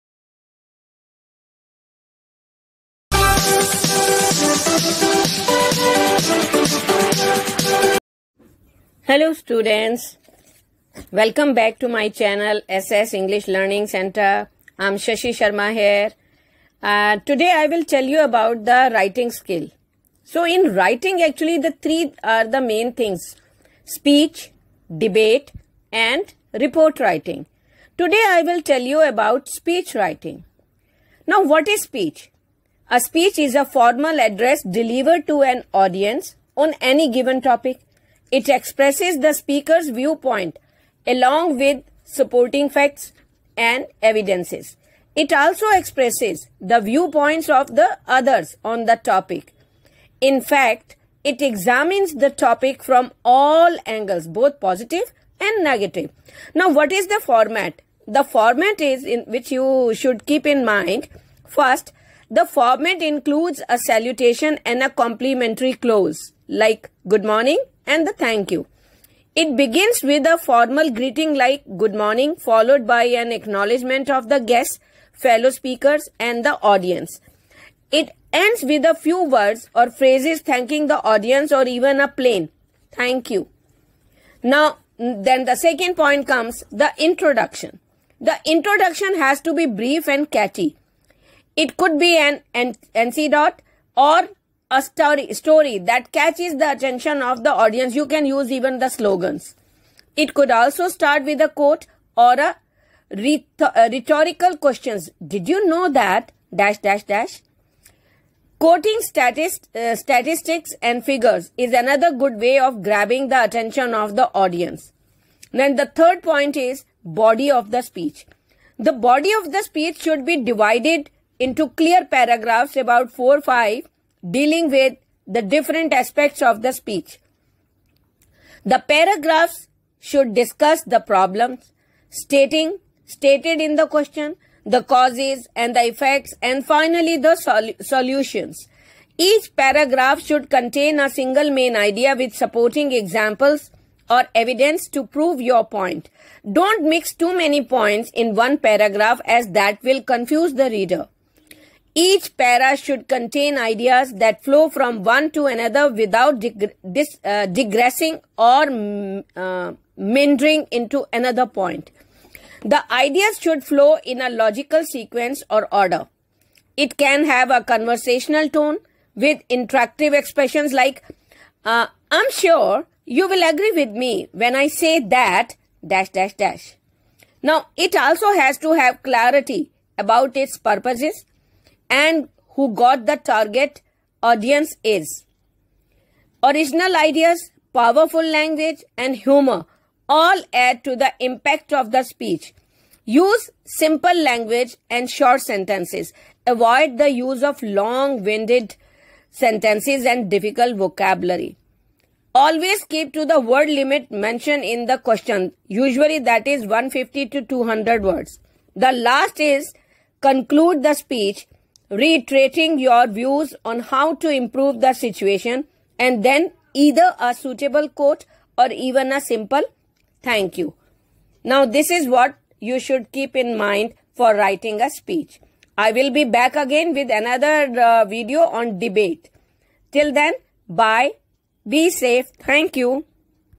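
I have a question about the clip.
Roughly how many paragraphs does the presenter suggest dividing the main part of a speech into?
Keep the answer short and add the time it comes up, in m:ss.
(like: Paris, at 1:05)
4 to 5, at 2:02.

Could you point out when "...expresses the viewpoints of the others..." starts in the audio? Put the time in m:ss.
0:45.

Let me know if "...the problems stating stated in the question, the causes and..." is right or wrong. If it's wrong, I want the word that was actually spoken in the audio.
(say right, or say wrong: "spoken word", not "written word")
right.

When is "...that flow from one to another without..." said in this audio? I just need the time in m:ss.
2:34.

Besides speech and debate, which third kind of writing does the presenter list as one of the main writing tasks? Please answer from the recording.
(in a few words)
Report writing.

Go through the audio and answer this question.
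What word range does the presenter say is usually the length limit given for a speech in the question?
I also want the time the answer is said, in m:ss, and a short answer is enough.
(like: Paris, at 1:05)
150 to 200 words, at 3:26.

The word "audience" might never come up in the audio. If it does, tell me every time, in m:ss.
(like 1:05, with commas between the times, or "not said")
0:35, 1:16, 1:21, 1:37, 1:54, 3:04.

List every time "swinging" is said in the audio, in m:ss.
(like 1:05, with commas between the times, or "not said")
not said.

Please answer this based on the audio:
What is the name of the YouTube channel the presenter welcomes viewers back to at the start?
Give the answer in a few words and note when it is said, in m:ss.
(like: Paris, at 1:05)
SS English Learning Center, at 0:12.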